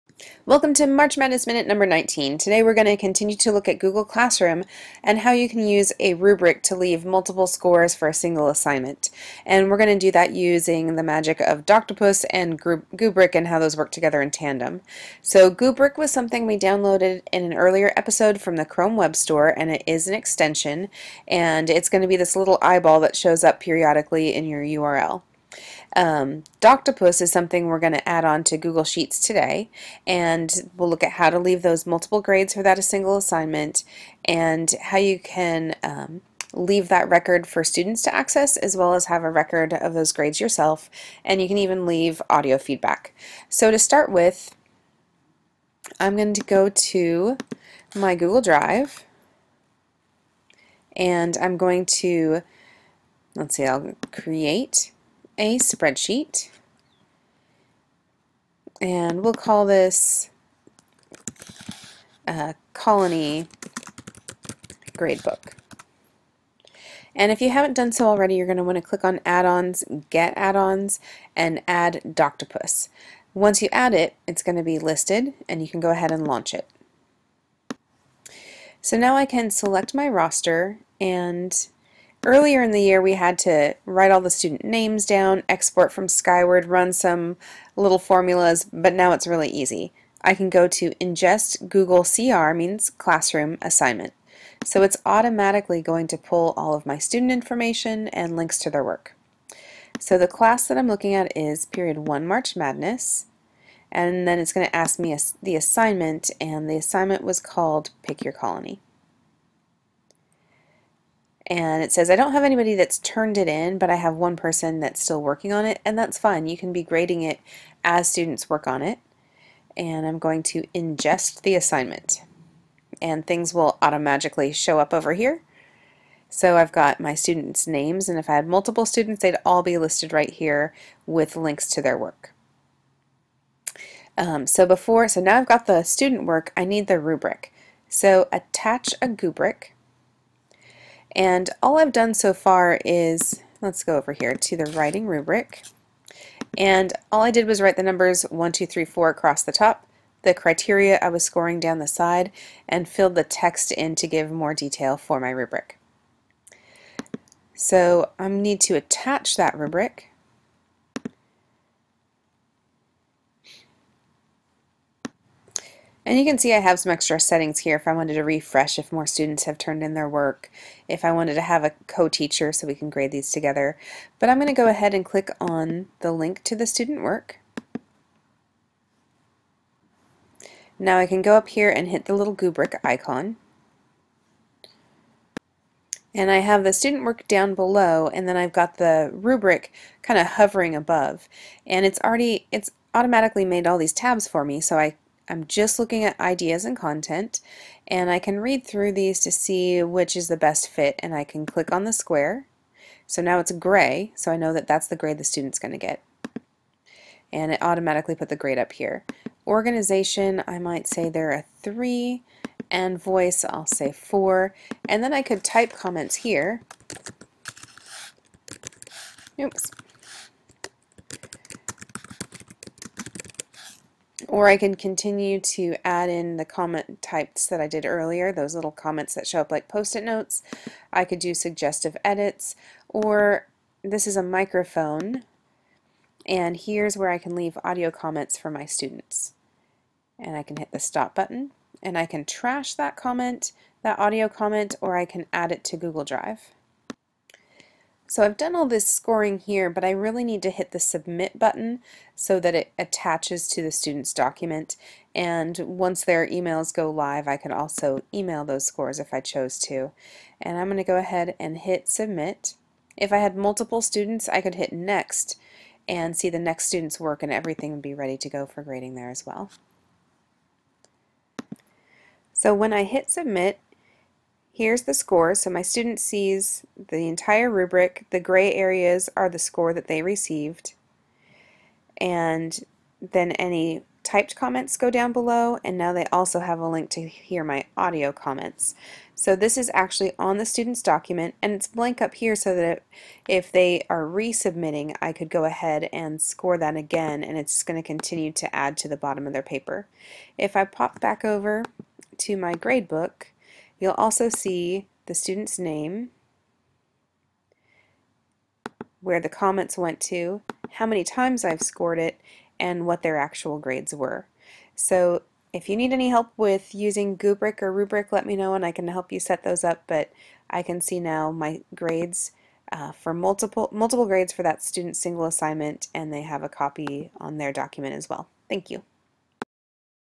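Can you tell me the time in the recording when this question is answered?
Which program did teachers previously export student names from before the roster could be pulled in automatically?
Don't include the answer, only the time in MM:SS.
01:26.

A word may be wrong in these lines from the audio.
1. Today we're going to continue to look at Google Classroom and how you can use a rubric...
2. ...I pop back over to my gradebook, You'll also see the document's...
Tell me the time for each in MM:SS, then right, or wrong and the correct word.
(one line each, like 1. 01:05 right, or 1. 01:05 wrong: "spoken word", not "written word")
1. 00:02 right
2. 05:00 wrong: "student", not "document".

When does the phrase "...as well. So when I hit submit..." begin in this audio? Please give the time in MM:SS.
04:29.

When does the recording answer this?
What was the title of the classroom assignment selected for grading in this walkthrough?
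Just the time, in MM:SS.
01:48.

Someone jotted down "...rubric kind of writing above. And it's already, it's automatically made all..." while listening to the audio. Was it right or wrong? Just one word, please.
wrong.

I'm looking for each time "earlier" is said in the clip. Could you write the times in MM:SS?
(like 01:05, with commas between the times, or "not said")
00:17, 01:22, 03:47.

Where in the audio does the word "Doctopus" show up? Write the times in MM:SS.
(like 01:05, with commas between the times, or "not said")
00:11, 00:26, 01:12.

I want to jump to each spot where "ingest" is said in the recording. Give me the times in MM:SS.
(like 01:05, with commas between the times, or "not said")
01:31, 02:00.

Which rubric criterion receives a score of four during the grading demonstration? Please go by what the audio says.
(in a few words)
voice.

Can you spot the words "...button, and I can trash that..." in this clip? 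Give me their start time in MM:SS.
04:01.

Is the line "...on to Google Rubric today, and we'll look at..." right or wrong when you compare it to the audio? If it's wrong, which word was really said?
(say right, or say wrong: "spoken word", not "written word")
wrong: "Sheets", not "Rubric".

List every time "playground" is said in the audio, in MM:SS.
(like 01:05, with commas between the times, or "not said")
not said.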